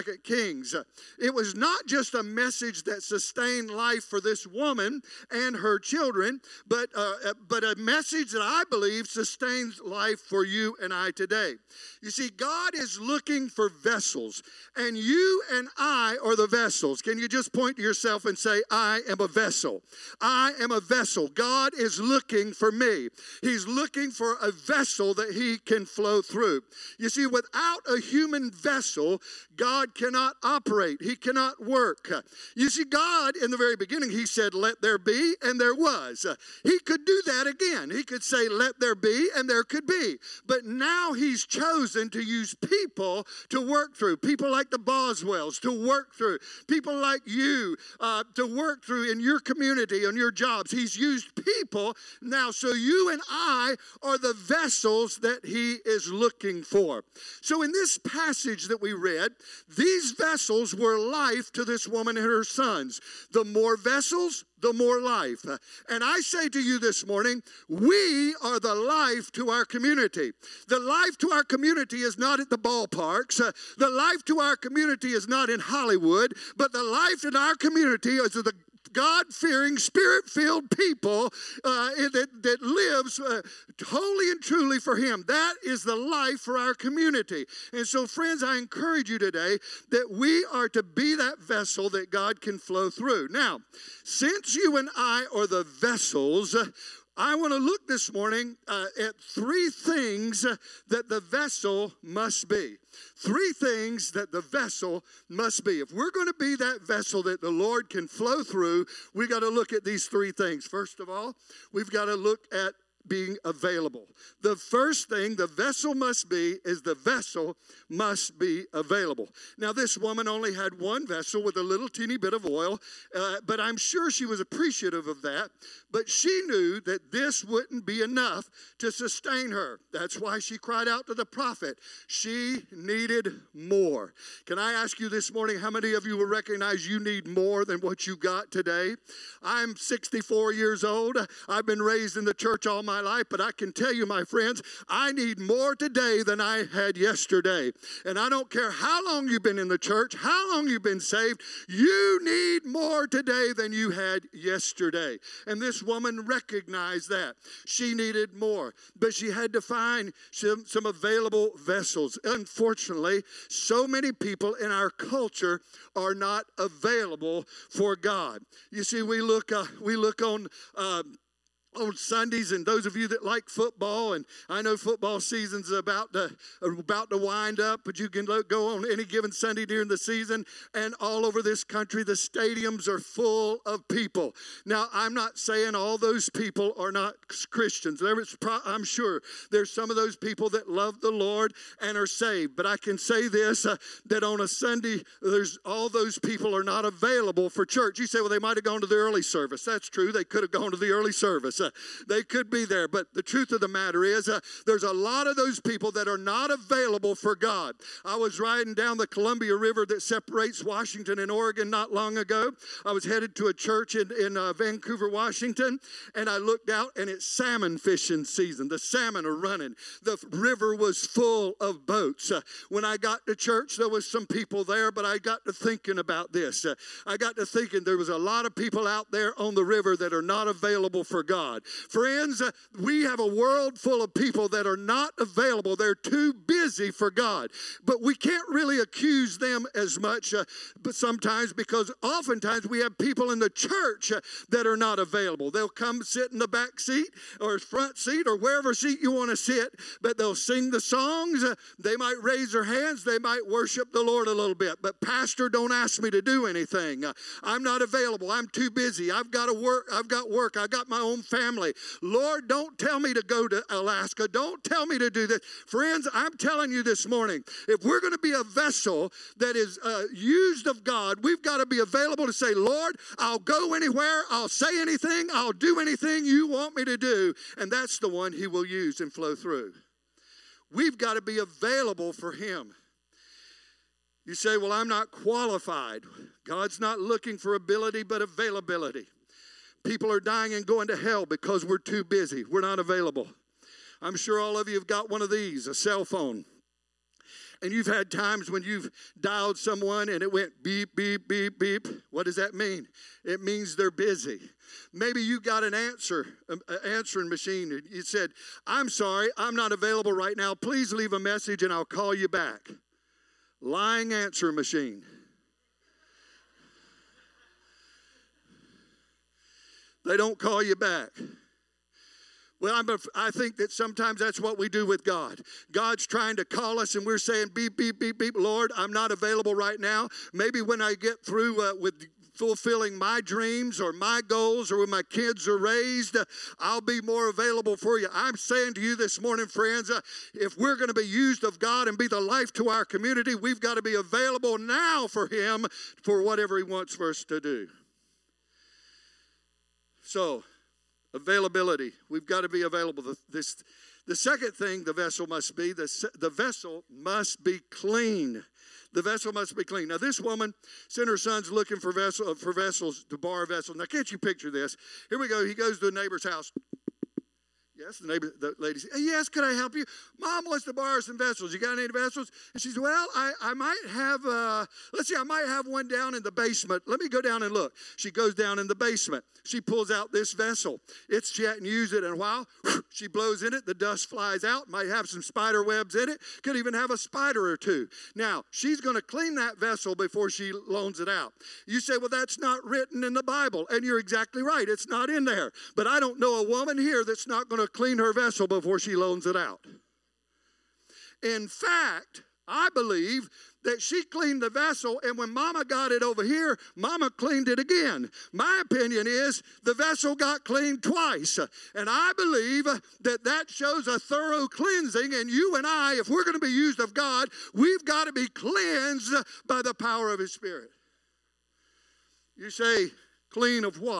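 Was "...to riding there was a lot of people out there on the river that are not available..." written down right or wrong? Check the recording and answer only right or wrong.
wrong.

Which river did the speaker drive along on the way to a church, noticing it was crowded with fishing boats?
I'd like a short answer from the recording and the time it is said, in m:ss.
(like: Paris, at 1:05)
Columbia River, at 3:29.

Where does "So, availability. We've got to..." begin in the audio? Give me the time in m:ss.
5:50.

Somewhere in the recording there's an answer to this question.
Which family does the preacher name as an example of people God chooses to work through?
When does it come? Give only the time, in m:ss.
0:44.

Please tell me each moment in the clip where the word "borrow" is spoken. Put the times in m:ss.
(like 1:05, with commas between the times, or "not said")
6:03, 6:10.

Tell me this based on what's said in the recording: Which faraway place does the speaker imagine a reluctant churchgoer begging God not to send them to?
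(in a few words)
Alaska.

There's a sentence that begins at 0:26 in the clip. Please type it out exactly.
You see, without a human vessel, God cannot operate, He cannot work.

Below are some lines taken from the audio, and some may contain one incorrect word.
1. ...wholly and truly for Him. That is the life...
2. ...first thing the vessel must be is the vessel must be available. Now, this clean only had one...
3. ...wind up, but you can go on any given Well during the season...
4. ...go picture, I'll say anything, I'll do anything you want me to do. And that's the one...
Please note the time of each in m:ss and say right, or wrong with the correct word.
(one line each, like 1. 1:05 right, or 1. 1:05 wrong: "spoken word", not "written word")
1. 1:23 right
2. 1:54 wrong: "woman", not "clean"
3. 2:57 wrong: "Sunday", not "Well"
4. 4:33 wrong: "anywhere", not "picture".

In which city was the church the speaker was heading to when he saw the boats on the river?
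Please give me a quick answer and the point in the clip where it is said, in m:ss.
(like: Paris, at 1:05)
Vancouver, Washington, at 3:34.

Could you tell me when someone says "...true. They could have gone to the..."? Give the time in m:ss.
3:19.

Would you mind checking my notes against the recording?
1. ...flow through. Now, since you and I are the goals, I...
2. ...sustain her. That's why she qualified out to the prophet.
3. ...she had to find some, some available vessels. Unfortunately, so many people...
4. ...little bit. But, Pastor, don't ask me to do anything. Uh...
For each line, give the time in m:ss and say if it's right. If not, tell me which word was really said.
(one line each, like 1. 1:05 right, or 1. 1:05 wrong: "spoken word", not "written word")
1. 1:32 wrong: "vessels", not "goals"
2. 2:08 wrong: "cried", not "qualified"
3. 2:39 right
4. 4:14 right.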